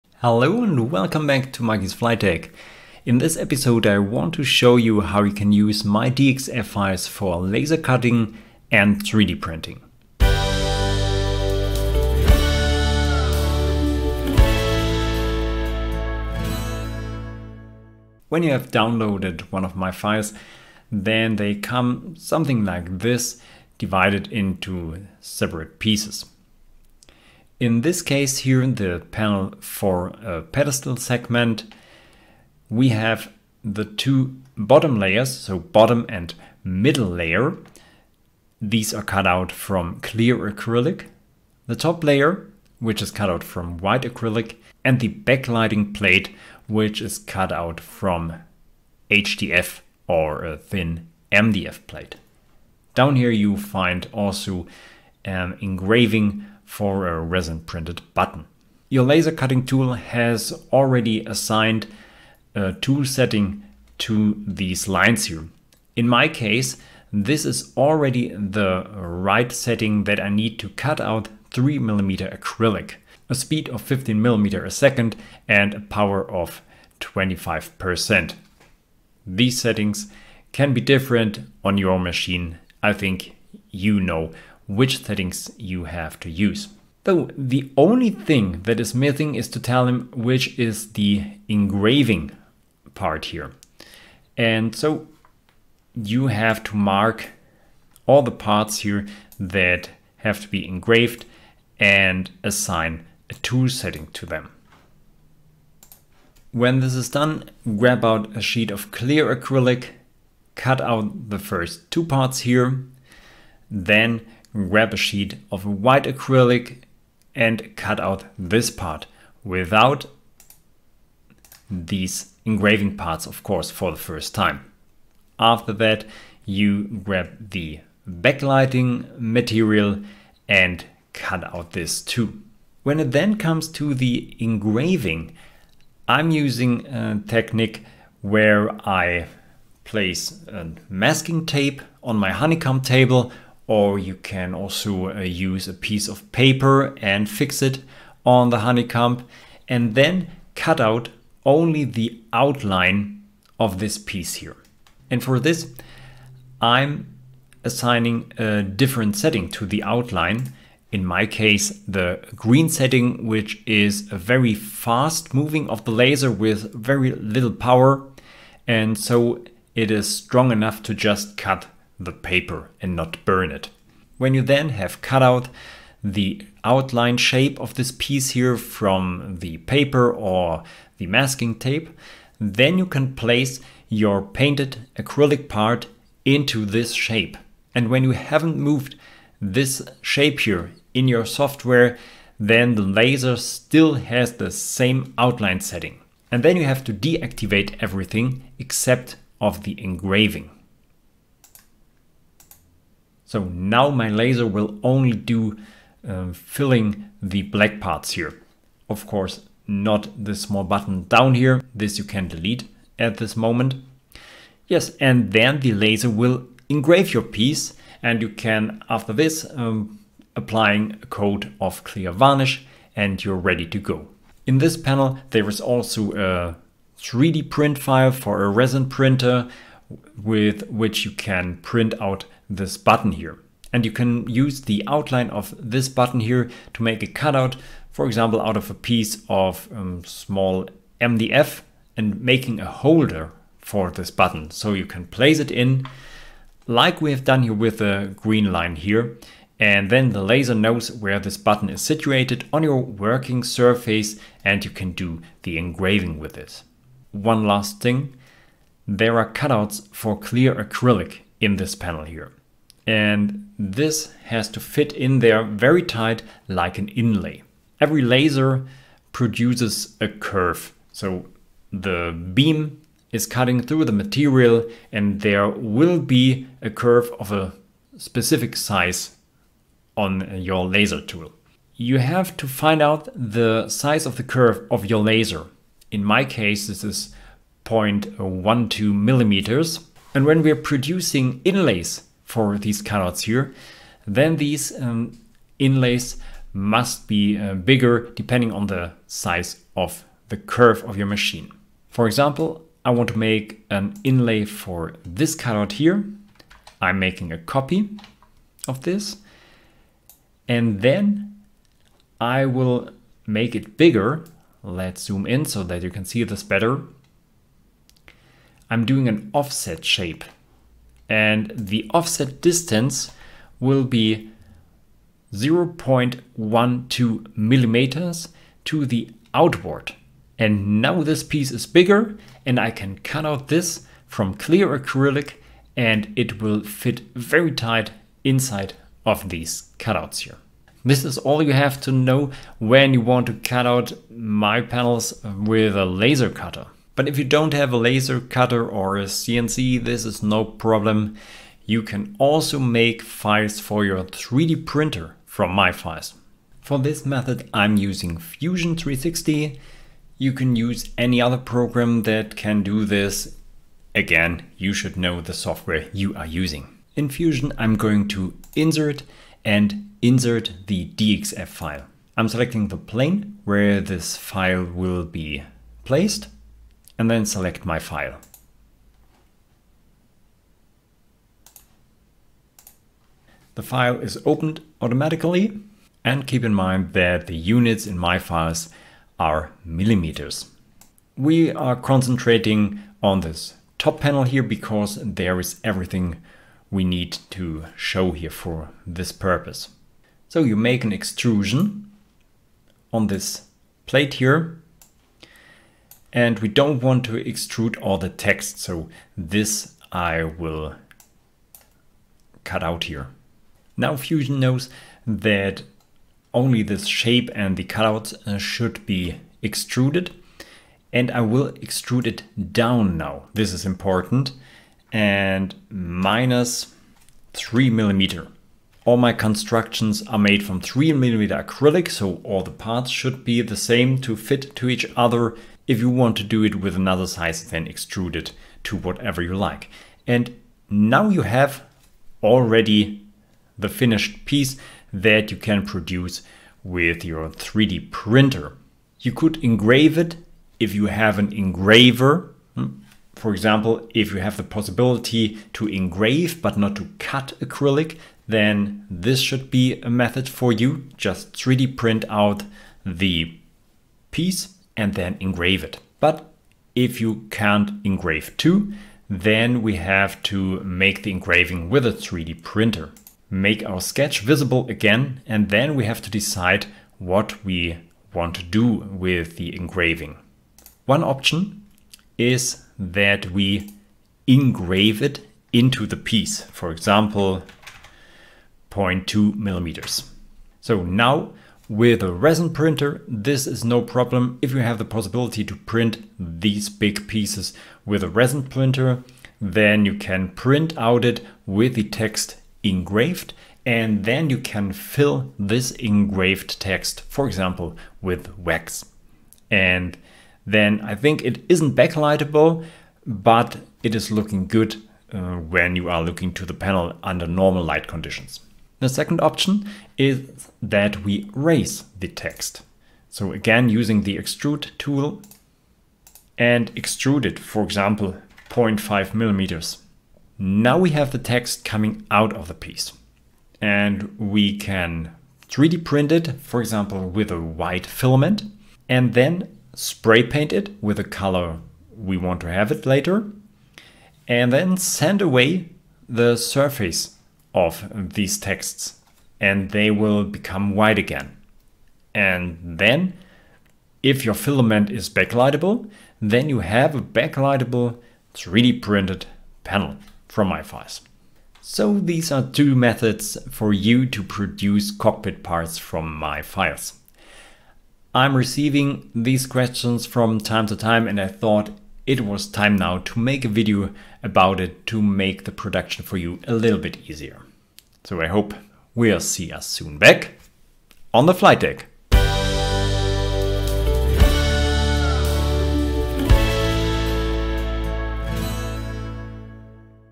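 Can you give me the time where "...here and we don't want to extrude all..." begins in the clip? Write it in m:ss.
6:44.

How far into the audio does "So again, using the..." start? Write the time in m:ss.
8:43.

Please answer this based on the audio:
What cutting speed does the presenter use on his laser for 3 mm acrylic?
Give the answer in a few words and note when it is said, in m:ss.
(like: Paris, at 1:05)
15 mm a second, at 1:13.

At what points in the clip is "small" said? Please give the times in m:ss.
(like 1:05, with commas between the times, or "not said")
3:30, 4:00.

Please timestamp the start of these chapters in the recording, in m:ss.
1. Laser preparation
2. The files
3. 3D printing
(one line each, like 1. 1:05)
1. 0:58
2. 0:18
3. 5:47.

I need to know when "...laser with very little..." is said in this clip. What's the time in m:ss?
2:45.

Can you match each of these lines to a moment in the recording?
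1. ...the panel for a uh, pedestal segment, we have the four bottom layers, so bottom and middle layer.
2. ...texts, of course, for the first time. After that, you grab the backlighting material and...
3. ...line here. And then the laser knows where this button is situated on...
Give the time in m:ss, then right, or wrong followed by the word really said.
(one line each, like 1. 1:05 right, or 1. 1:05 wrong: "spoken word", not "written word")
1. 0:28 wrong: "two", not "four"
2. 2:02 wrong: "parts", not "texts"
3. 4:08 right.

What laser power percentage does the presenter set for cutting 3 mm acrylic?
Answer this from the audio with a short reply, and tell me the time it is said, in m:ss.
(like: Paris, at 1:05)
25%, at 1:17.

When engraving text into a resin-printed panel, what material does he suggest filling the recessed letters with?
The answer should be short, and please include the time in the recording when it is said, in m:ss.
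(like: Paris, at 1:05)
Wax, at 8:28.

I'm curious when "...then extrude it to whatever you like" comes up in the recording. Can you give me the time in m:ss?
7:17.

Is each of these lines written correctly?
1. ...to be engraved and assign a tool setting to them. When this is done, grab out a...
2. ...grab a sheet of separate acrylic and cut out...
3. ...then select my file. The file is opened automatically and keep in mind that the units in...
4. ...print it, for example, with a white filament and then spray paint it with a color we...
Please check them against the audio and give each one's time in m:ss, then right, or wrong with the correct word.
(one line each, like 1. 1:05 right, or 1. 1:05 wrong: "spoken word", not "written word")
1. 1:40 right
2. 1:54 wrong: "white", not "separate"
3. 6:17 right
4. 8:55 right.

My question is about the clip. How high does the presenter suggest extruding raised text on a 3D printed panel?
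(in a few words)
0.5 millimeters.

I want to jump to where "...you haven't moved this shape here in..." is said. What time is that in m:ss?
3:08.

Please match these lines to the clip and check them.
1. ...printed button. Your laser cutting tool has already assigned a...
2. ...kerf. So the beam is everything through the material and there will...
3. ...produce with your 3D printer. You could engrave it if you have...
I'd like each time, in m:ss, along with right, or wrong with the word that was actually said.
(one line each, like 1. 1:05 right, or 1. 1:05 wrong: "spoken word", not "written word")
1. 0:57 right
2. 4:30 wrong: "cutting", not "everything"
3. 7:25 right.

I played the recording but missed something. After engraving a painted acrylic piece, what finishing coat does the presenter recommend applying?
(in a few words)
Clear varnish.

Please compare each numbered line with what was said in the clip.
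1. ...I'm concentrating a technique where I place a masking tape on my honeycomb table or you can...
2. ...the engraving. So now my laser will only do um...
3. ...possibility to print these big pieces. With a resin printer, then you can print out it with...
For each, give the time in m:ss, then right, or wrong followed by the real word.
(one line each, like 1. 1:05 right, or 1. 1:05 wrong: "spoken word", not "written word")
1. 2:16 wrong: "using", not "concentrating"
2. 3:19 right
3. 8:14 right.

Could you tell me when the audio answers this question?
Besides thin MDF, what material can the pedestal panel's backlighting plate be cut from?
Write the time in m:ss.
0:49.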